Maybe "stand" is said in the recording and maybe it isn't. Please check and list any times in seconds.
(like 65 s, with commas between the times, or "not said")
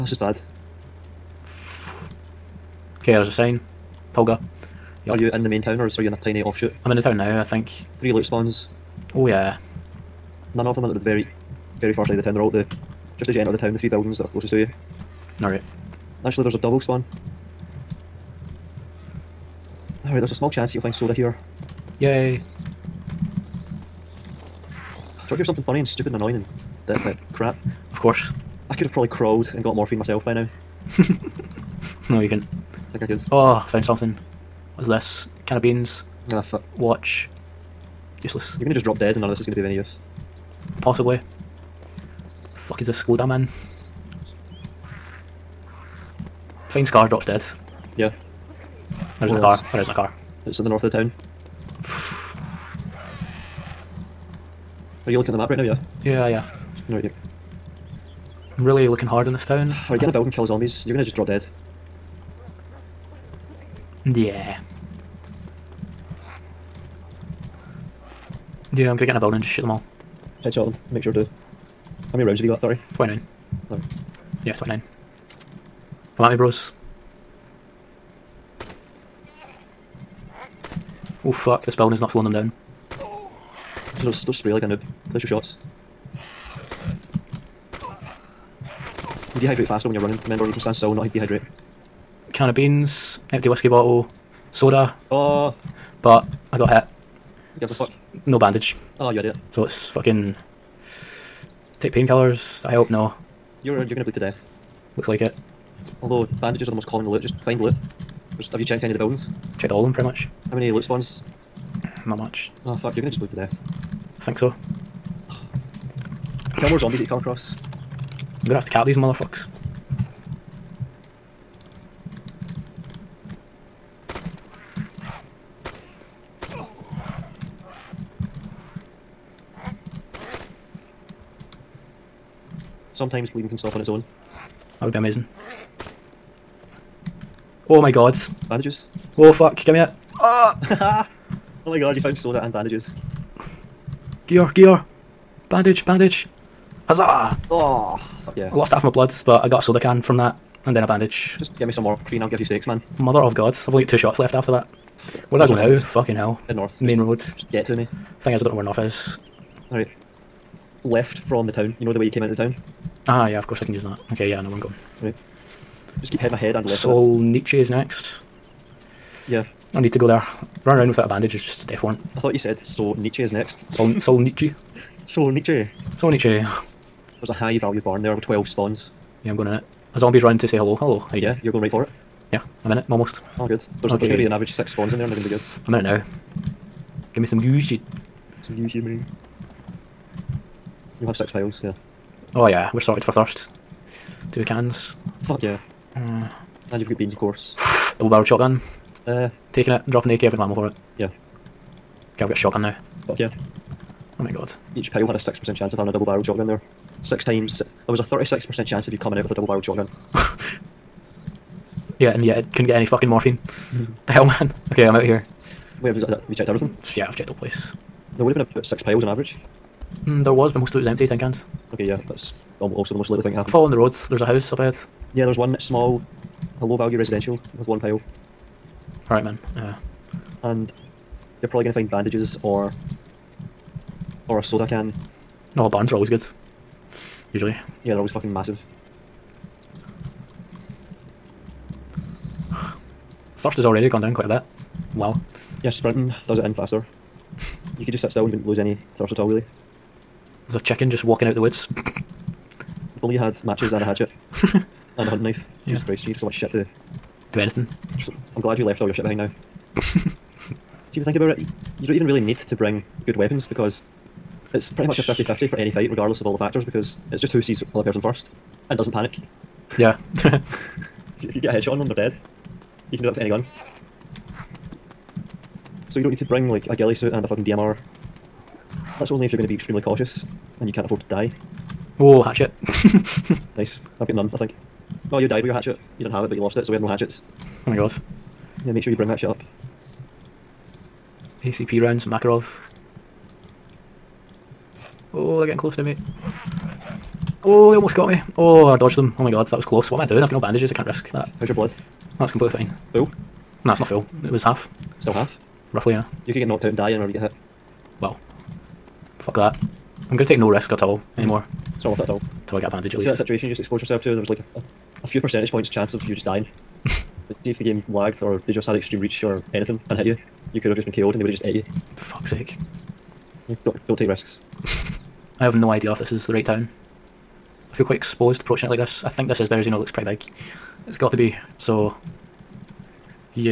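90 s.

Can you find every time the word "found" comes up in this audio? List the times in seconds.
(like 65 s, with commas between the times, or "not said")
33 s, 142 s.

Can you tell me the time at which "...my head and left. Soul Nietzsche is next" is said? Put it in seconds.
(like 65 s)
166 s.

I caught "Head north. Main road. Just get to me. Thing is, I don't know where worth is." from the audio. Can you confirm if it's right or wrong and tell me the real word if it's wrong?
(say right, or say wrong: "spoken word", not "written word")
wrong: "north", not "worth".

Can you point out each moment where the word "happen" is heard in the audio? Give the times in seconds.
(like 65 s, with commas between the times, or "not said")
223 s.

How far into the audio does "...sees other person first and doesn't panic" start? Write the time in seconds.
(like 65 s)
267 s.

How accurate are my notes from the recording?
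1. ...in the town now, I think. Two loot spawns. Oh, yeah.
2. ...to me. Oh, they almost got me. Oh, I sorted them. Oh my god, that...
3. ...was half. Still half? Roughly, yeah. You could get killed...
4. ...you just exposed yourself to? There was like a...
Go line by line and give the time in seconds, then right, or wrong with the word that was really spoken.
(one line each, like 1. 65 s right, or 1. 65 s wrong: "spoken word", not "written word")
1. 6 s wrong: "Three", not "Two"
2. 295 s wrong: "dodged", not "sorted"
3. 304 s wrong: "knocked", not "killed"
4. 313 s right.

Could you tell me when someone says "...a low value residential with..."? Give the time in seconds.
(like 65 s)
226 s.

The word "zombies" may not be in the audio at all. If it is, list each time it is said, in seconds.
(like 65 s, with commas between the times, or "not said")
60 s, 116 s, 179 s.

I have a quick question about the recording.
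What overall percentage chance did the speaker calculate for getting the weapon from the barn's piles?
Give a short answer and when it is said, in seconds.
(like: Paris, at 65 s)
36%, at 208 s.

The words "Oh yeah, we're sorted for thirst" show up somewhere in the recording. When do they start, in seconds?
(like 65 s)
192 s.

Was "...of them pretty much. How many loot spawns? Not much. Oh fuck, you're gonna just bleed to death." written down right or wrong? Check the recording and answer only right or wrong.
right.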